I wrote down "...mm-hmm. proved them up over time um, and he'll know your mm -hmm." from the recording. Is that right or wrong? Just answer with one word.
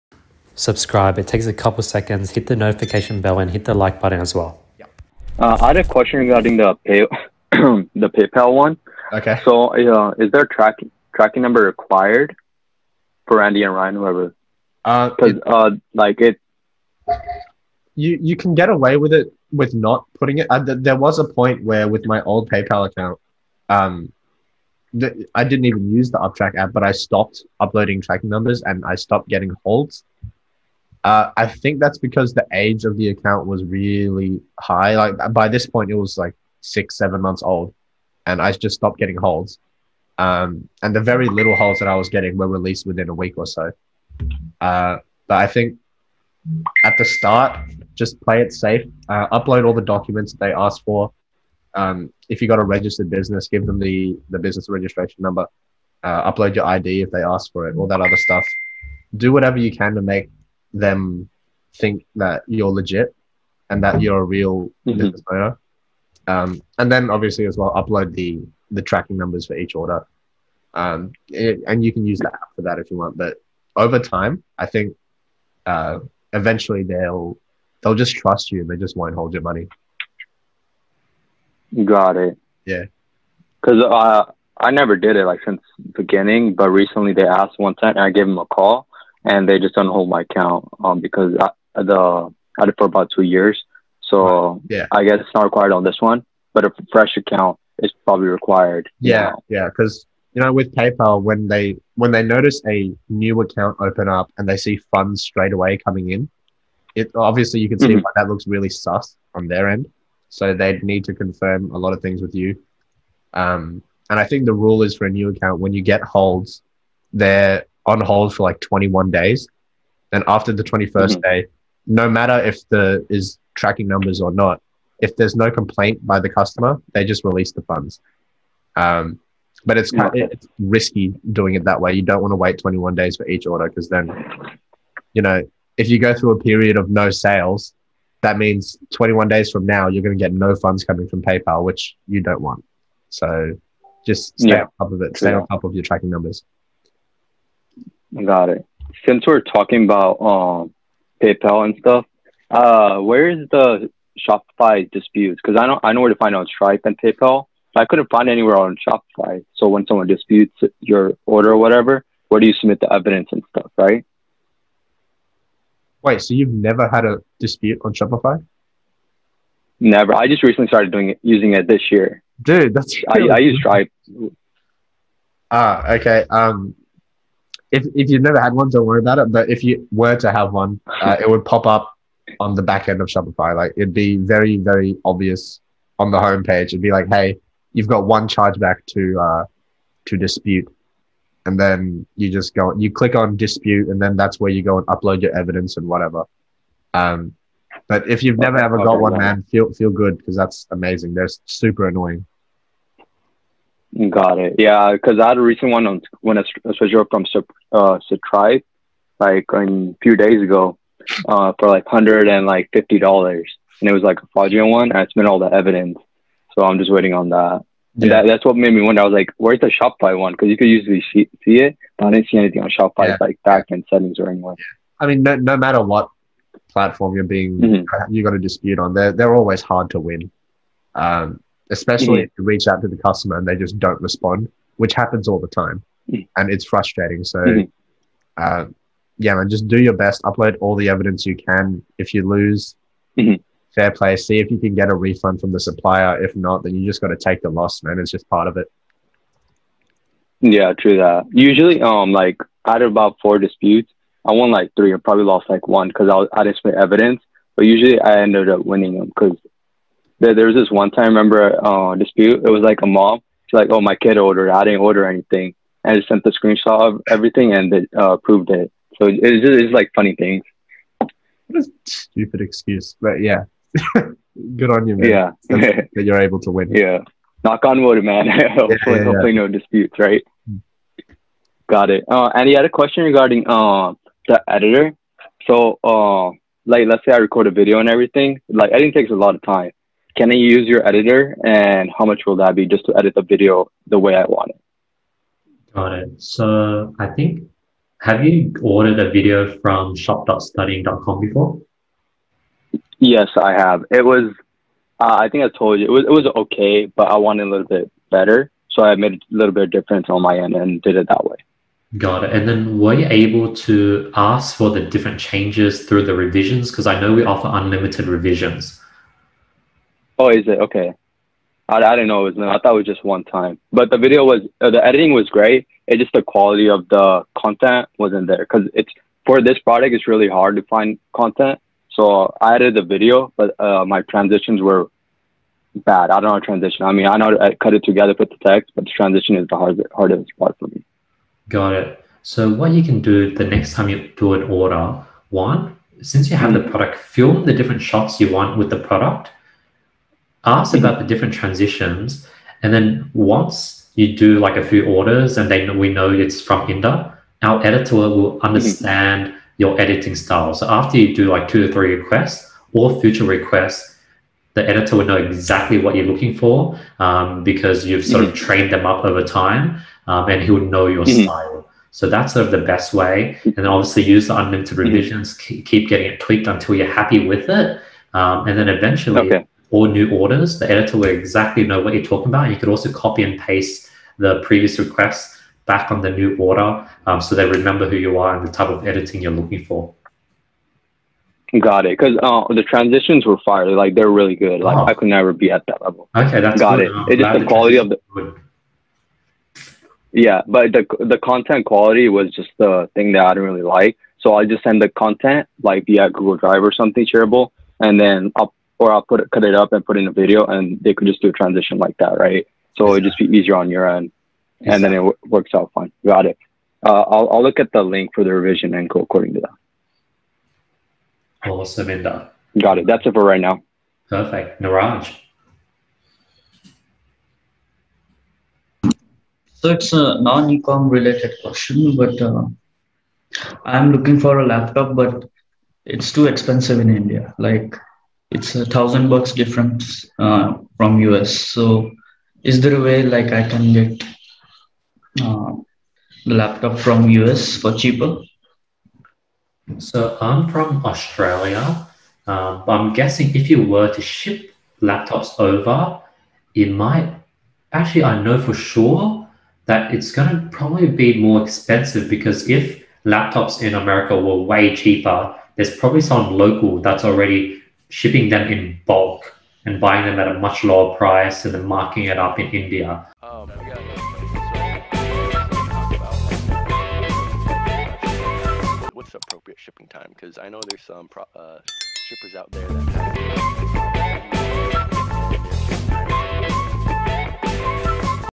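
wrong.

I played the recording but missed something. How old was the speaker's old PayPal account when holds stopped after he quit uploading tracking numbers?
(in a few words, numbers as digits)
6-7 months.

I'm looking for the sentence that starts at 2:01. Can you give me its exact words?
day, no matter if the is tracking numbers or not, if there's no complaint by the customer, they just release the funds.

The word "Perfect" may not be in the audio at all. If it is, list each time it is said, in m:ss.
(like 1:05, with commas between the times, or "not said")
7:04.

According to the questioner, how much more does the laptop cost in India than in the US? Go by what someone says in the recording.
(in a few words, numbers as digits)
$1,000.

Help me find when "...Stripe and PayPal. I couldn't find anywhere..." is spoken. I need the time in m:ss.
2:36.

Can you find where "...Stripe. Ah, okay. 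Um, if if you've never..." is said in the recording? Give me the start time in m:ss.
2:53.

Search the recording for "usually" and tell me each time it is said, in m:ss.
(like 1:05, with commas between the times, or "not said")
3:40, 4:11, 4:17.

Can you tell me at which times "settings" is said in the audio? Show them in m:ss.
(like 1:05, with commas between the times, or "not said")
3:43.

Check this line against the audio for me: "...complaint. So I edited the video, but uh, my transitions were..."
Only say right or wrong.
wrong.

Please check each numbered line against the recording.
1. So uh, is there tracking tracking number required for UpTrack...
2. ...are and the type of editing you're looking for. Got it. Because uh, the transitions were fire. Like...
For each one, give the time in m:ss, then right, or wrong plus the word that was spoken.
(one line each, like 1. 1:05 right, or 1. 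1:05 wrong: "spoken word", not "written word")
1. 0:09 wrong: "Andy", not "UpTrack"
2. 6:28 right.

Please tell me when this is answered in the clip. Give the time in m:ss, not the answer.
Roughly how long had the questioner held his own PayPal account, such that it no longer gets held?
1:32.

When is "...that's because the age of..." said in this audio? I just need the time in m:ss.
0:31.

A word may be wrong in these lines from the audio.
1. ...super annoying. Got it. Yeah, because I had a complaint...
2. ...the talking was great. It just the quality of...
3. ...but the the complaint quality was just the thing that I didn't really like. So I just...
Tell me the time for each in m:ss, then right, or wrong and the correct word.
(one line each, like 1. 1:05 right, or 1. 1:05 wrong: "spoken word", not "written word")
1. 3:21 wrong: "recent", not "complaint"
2. 5:24 wrong: "editing", not "talking"
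3. 6:40 wrong: "content", not "complaint".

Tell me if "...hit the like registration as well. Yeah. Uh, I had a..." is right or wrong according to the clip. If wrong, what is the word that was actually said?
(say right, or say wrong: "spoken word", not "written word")
wrong: "button", not "registration".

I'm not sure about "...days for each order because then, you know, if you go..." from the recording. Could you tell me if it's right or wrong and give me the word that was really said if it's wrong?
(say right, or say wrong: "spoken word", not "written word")
right.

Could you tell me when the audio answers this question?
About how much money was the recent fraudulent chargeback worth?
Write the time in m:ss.
3:31.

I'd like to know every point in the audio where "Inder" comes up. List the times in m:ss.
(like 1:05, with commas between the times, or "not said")
5:56, 7:01.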